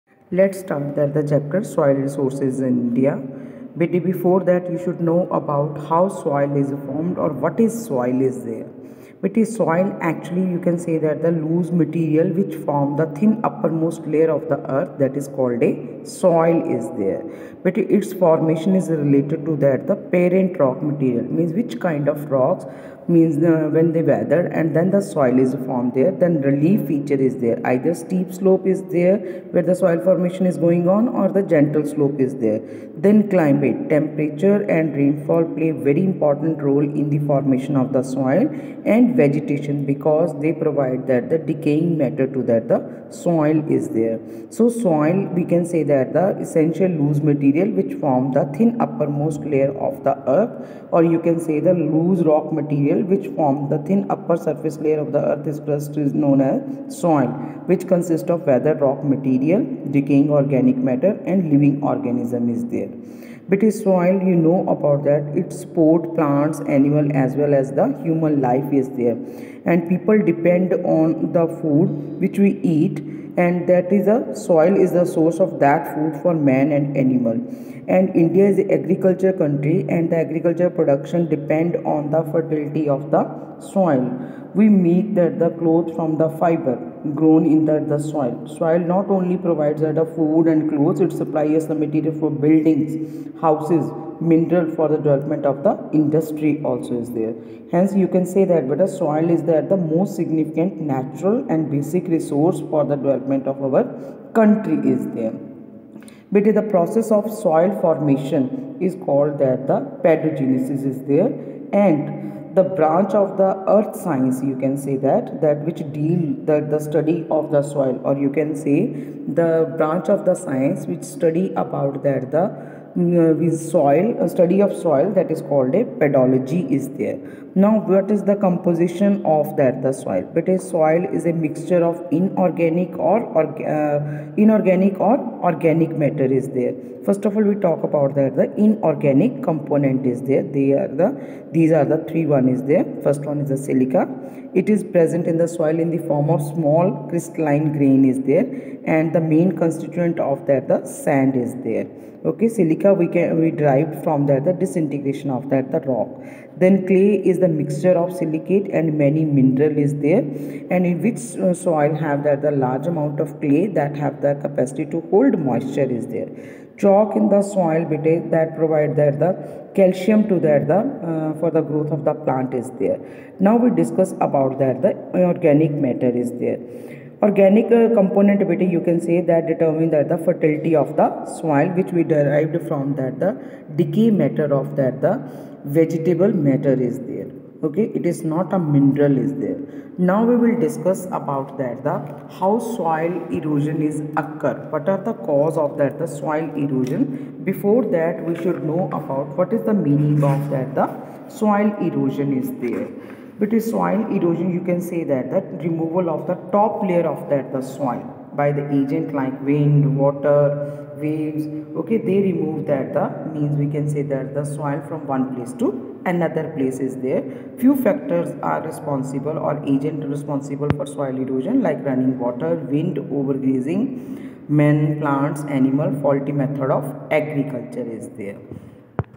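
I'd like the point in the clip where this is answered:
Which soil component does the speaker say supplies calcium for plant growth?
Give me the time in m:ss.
2:46.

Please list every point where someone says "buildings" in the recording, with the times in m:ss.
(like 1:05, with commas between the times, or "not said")
1:32.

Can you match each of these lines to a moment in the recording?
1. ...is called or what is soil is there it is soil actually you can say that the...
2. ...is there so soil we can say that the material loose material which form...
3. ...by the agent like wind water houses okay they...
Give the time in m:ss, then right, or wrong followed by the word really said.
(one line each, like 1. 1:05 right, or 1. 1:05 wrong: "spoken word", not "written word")
1. 0:06 wrong: "formed", not "called"
2. 0:43 wrong: "essential", not "material"
3. 3:28 wrong: "waves", not "houses".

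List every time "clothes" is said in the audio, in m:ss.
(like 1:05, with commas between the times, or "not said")
1:25, 1:30.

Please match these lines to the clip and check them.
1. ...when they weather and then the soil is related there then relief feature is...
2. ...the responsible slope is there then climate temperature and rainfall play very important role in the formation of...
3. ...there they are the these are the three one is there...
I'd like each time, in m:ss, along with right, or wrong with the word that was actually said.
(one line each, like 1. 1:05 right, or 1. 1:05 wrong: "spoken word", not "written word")
1. 0:23 wrong: "formed", not "related"
2. 0:31 wrong: "gentle", not "responsible"
3. 2:20 right.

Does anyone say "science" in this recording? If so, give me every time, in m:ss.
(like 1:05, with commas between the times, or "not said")
1:54, 2:00.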